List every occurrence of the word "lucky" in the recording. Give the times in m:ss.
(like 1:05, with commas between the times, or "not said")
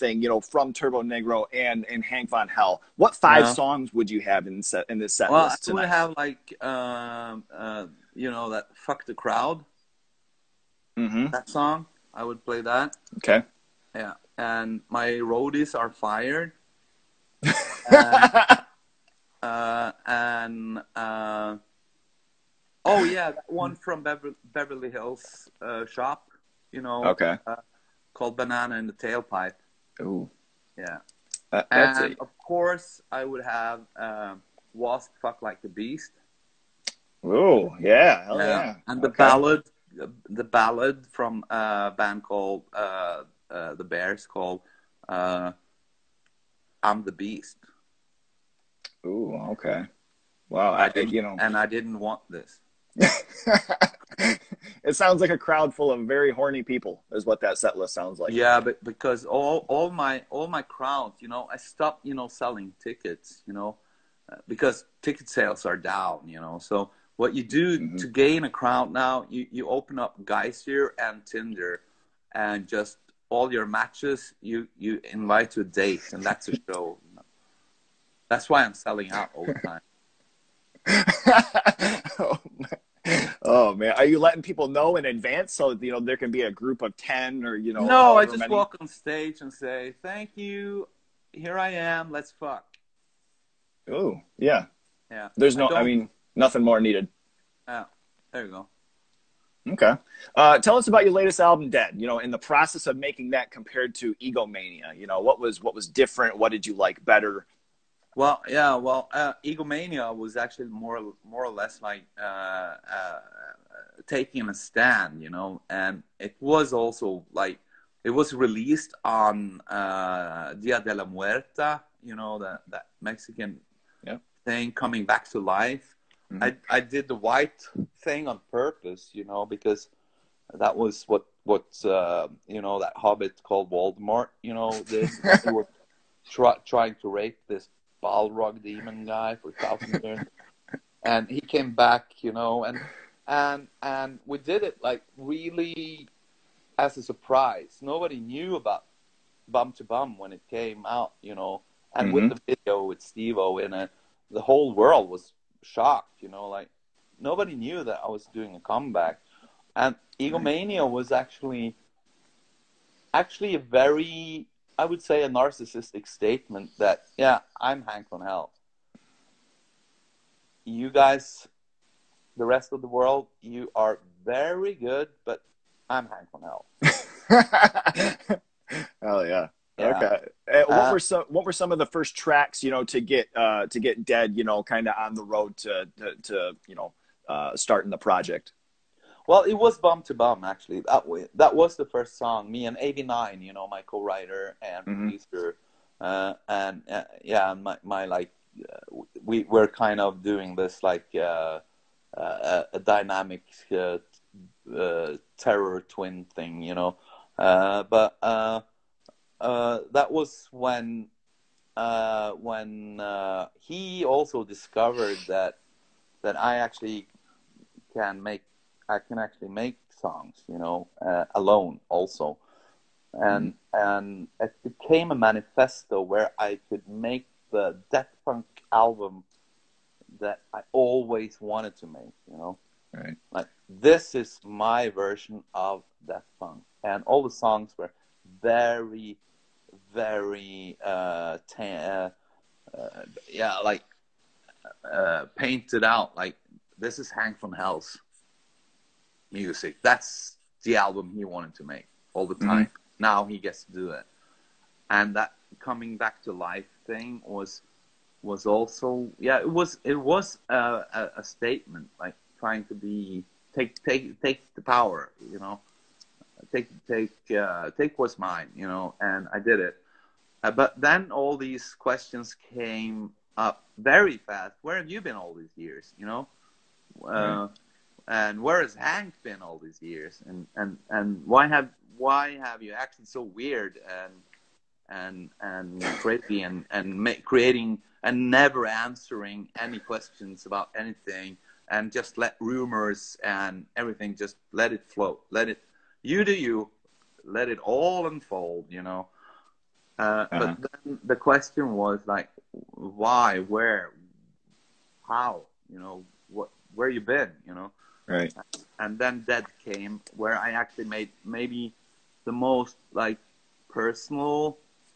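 not said.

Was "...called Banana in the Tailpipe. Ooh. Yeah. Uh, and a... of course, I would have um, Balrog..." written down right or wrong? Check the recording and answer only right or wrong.
wrong.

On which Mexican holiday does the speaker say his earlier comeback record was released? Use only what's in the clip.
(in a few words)
Dia de la Muerta.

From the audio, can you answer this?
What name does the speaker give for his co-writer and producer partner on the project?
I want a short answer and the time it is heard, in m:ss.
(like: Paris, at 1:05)
AV9, at 3:12.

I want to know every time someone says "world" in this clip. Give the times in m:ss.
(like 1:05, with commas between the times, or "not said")
2:34, 2:52.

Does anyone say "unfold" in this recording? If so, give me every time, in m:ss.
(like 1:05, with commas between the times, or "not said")
4:58.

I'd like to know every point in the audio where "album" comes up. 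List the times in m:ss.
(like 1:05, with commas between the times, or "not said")
1:41, 3:48, 4:10.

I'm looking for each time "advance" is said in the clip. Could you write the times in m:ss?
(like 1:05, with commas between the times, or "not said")
1:25.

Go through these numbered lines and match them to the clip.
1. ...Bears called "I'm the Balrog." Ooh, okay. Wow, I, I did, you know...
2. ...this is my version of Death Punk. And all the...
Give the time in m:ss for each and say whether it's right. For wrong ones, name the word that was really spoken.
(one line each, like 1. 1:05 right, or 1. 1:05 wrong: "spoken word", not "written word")
1. 0:43 wrong: "Beast", not "Balrog"
2. 3:53 right.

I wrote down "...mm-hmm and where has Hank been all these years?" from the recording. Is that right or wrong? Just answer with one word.
right.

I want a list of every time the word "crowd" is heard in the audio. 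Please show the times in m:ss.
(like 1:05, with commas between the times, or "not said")
0:09, 0:55, 1:00, 1:08.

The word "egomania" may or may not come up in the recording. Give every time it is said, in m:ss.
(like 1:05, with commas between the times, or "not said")
1:44, 1:49, 2:40.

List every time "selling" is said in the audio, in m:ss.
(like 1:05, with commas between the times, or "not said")
1:02, 1:18.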